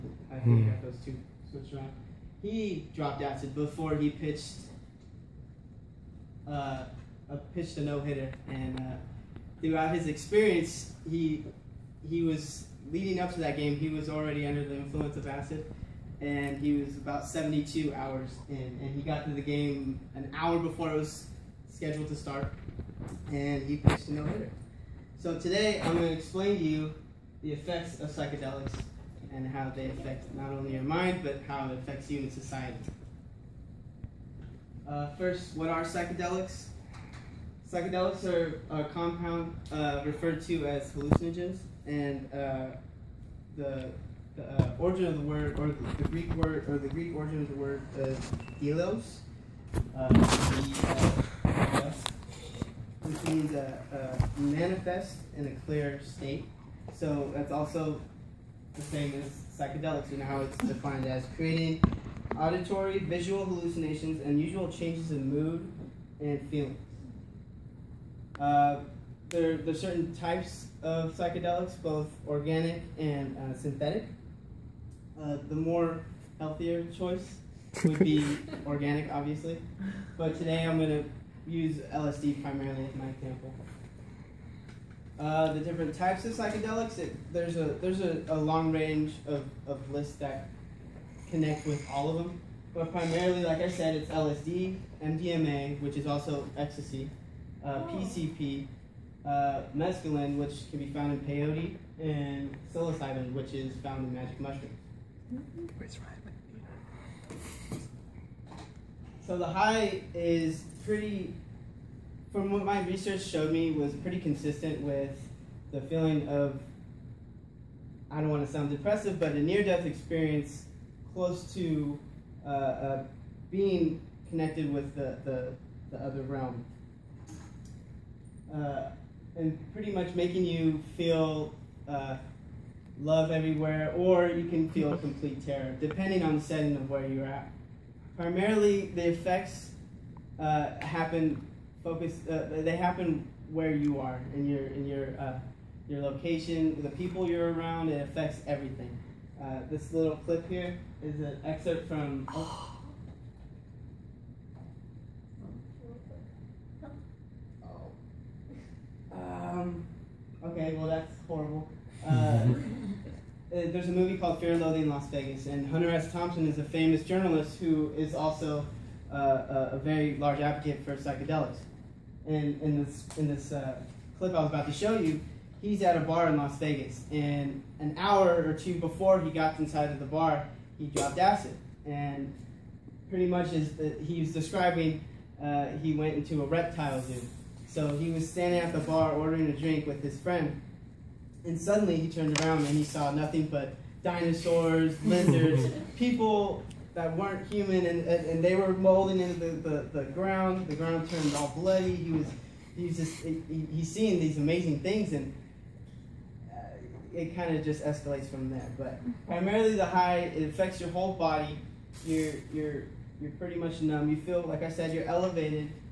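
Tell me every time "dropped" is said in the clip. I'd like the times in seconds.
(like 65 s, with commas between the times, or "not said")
2 s, 180 s.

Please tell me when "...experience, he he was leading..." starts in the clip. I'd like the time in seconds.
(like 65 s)
10 s.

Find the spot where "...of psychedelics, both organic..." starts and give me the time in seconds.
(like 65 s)
70 s.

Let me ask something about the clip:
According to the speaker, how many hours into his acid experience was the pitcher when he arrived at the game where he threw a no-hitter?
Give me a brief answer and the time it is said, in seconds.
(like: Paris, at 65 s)
72, at 17 s.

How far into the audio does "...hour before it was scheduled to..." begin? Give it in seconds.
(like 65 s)
20 s.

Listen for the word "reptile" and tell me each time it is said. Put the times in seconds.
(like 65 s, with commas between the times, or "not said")
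186 s.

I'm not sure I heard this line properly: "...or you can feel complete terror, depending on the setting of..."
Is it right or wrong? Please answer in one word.
right.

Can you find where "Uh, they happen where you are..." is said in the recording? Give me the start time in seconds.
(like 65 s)
142 s.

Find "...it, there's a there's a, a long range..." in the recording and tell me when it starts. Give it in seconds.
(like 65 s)
86 s.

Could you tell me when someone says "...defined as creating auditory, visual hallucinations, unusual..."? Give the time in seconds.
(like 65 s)
60 s.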